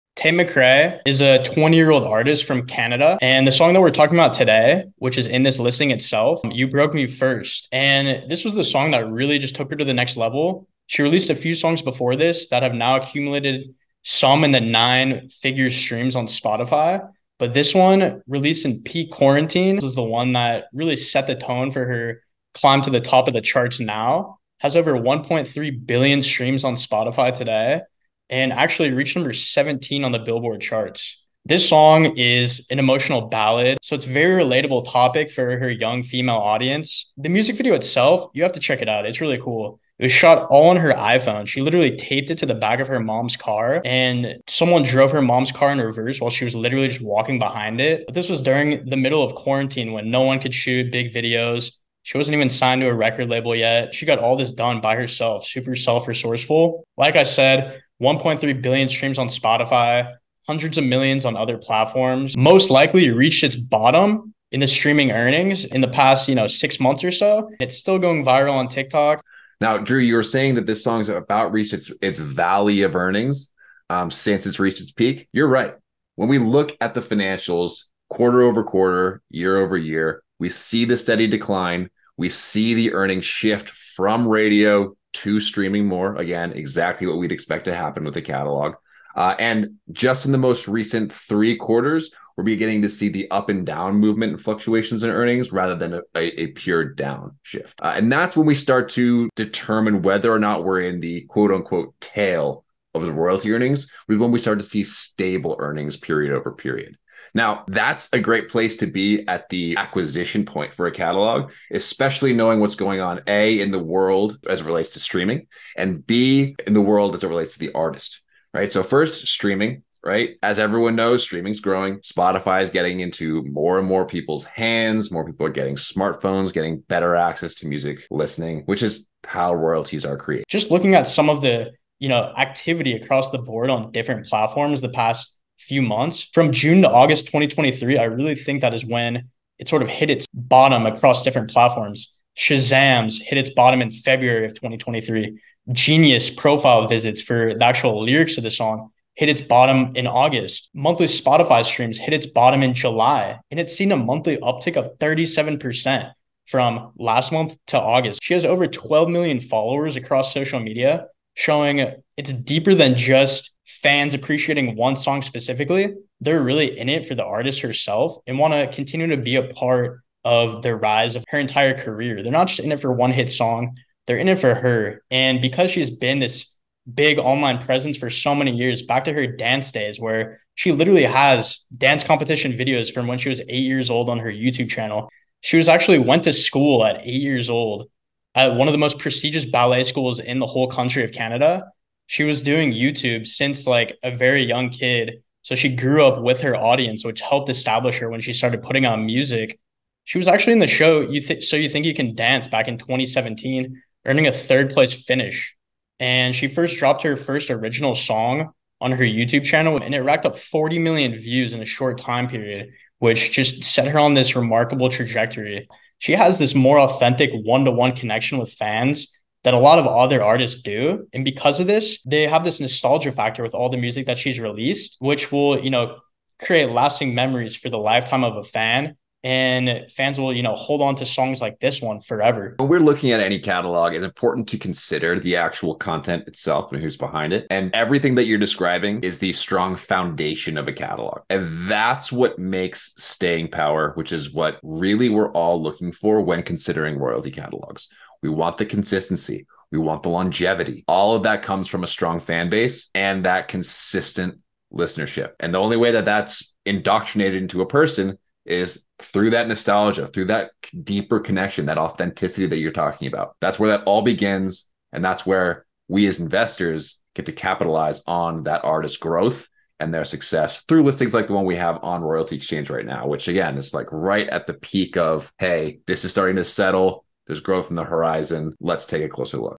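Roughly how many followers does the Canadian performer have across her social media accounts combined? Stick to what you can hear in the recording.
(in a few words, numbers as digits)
12 million.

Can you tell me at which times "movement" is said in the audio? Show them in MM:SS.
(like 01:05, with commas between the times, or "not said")
01:33.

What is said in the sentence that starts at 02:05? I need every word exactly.
More people are getting smartphones, getting better access to music listening, which is how royalties are created.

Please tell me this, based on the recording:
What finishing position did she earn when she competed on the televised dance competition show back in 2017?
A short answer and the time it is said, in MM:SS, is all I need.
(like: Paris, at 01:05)
Third place, at 03:24.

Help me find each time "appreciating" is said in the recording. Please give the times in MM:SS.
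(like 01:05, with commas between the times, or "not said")
02:44.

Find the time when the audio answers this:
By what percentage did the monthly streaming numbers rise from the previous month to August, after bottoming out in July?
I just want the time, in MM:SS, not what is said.
02:34.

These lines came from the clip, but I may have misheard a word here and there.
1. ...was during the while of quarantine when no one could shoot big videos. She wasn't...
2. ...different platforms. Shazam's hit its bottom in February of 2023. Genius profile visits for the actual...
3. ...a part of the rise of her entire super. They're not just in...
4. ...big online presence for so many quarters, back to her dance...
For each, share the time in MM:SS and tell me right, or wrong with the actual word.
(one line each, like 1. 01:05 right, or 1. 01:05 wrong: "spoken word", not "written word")
1. 00:48 wrong: "middle", not "while"
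2. 02:21 right
3. 02:49 wrong: "career", not "super"
4. 02:56 wrong: "years", not "quarters".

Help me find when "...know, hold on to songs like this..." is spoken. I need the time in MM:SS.
03:50.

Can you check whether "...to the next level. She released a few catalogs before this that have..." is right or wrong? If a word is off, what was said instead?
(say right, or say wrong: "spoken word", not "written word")
wrong: "songs", not "catalogs".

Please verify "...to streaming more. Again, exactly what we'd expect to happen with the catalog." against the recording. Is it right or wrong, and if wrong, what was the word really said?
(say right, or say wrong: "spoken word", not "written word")
right.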